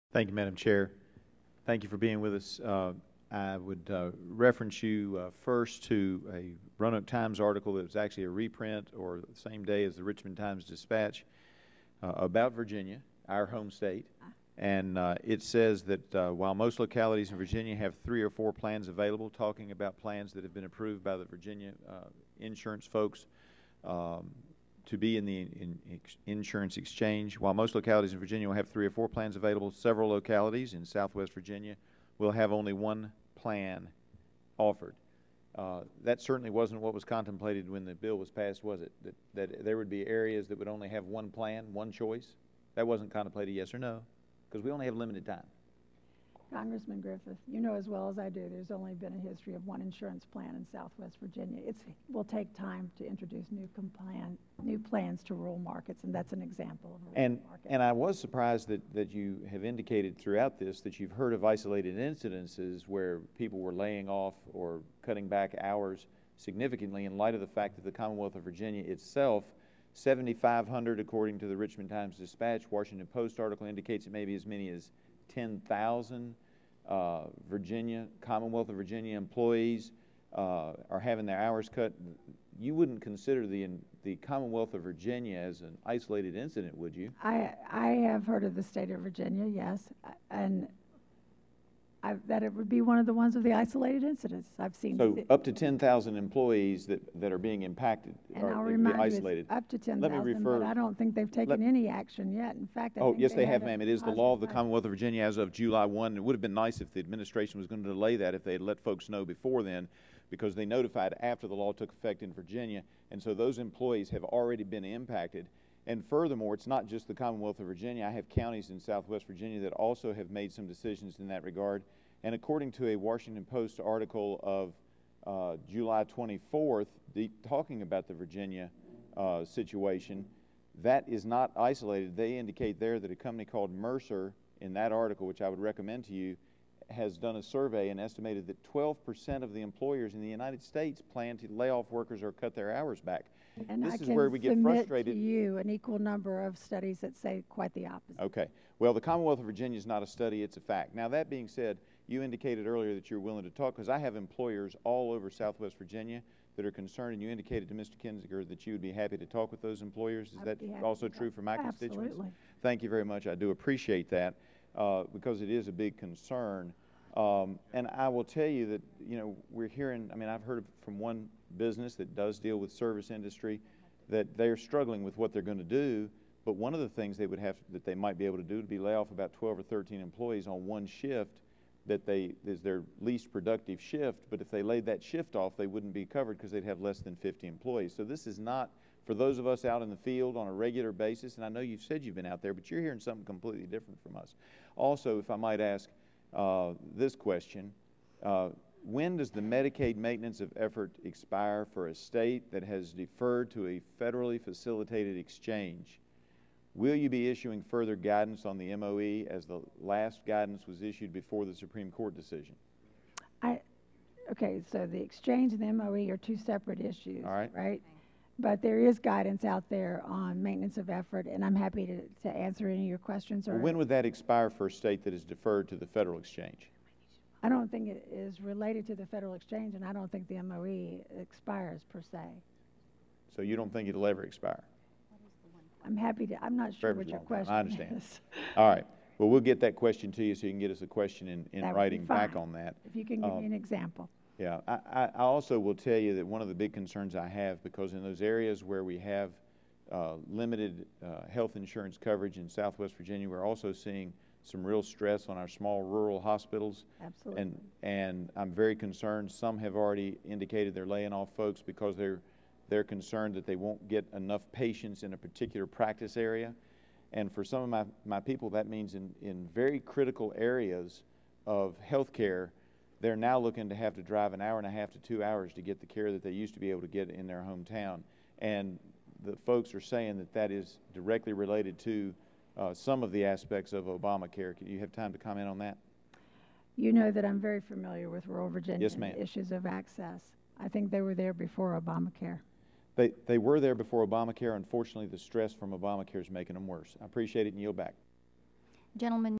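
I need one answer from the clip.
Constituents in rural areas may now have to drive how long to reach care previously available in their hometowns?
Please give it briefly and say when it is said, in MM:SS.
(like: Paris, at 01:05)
an hour and a half to two hours, at 04:34.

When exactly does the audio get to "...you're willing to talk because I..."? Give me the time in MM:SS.
02:33.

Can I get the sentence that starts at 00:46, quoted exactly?
Congressman Griffith, you know as well as I do, there's only been a history of one insurance plan in Southwest Virginia.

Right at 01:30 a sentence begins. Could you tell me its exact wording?
And I, that it would be one of the ones of the isolated incidents I've seen.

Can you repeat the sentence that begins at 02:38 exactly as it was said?
Kinzinger that you would be happy to talk with those employers.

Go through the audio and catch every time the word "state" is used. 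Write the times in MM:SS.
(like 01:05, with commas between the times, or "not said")
00:13, 01:28, 02:20, 03:21, 03:44.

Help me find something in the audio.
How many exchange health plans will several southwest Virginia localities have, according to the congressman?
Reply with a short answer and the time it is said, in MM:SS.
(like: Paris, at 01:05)
1, at 00:32.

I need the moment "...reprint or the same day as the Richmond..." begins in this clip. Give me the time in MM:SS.
00:08.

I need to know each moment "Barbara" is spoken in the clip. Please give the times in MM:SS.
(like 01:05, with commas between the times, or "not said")
not said.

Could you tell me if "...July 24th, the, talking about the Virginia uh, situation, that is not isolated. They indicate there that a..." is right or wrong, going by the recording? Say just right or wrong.
right.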